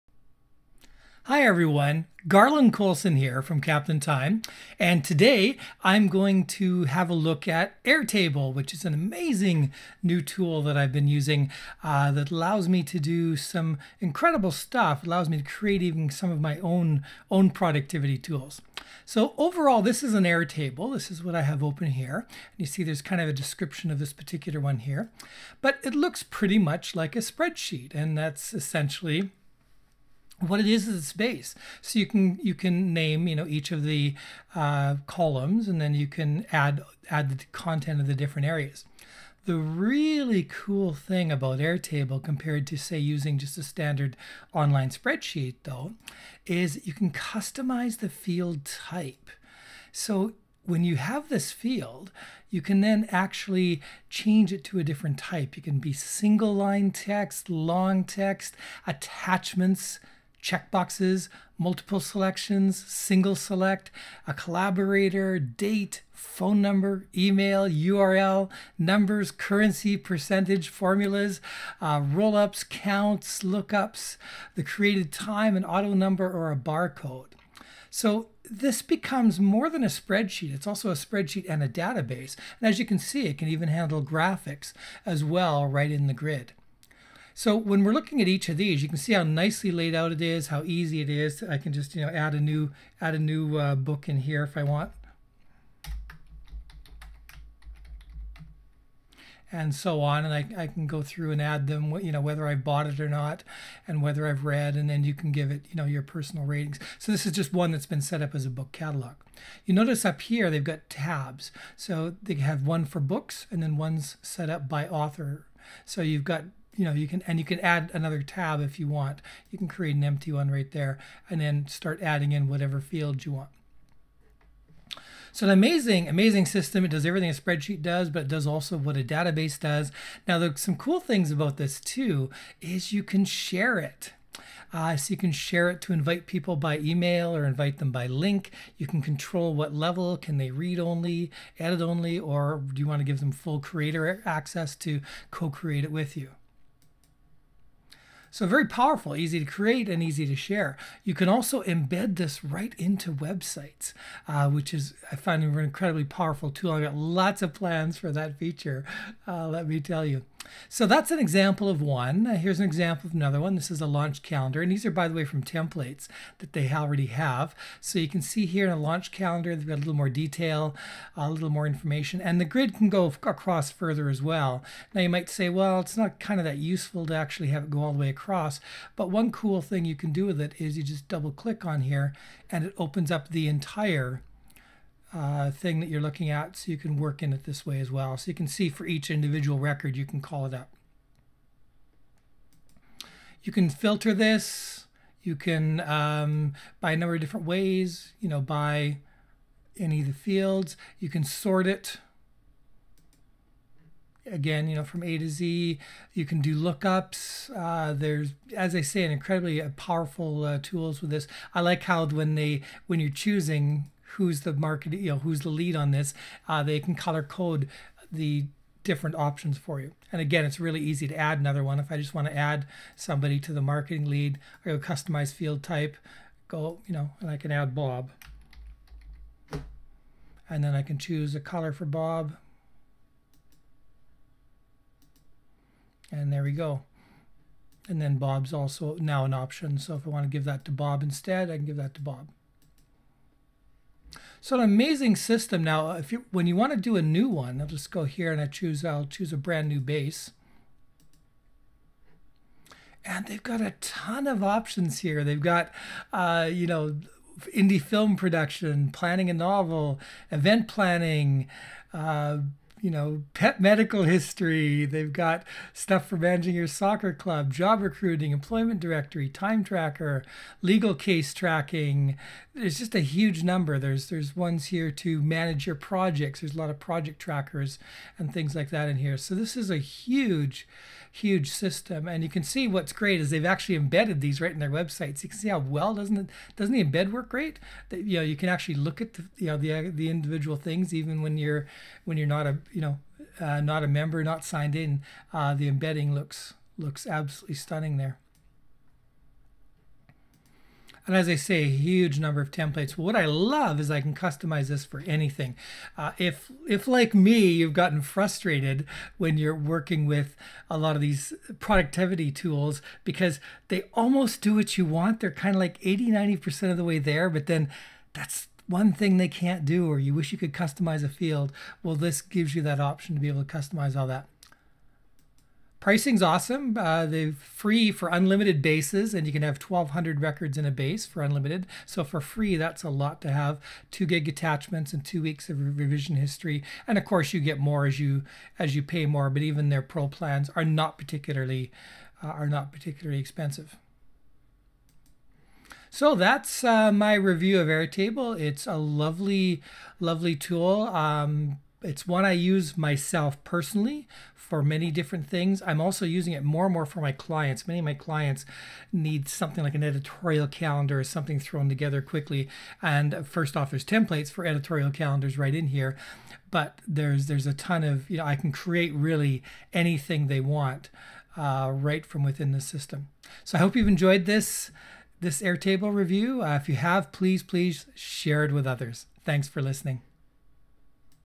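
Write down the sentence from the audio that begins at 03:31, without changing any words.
I like how when they, when you're choosing who's the market, you know, who's the lead on this.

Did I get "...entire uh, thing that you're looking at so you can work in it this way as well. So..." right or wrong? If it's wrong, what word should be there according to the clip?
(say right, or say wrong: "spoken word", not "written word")
right.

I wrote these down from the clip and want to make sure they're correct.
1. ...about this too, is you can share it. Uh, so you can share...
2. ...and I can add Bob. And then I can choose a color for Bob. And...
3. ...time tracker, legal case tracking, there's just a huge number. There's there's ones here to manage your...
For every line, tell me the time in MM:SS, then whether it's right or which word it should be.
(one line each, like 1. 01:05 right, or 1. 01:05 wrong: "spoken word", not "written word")
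1. 02:11 right
2. 03:47 right
3. 04:29 right.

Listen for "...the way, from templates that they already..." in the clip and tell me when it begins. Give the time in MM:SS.
02:45.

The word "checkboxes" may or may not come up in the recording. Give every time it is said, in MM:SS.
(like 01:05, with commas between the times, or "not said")
01:00.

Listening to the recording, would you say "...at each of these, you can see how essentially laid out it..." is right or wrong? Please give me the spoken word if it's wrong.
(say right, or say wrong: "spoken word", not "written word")
wrong: "nicely", not "essentially".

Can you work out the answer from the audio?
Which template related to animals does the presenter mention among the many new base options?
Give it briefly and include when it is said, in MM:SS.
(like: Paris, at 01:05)
Pet medical history, at 04:23.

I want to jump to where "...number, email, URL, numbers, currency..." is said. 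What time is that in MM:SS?
01:06.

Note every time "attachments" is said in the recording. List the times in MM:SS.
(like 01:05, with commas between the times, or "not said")
00:58, 05:34.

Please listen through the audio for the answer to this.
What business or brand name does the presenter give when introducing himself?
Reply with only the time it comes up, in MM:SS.
00:03.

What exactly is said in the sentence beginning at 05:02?
What I love is I can customize this for anything.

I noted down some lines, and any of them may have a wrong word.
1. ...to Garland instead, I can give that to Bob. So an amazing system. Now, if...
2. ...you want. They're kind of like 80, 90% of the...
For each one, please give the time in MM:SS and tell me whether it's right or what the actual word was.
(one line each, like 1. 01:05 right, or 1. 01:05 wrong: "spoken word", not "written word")
1. 04:00 wrong: "Bob", not "Garland"
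2. 05:14 right.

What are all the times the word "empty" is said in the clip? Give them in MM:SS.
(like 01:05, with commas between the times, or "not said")
02:00.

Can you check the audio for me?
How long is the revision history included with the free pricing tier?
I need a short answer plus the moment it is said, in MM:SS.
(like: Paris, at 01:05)
Two weeks, at 05:35.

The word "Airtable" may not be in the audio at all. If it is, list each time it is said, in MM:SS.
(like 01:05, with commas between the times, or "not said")
00:07, 00:20, 00:41, 05:47, 06:15.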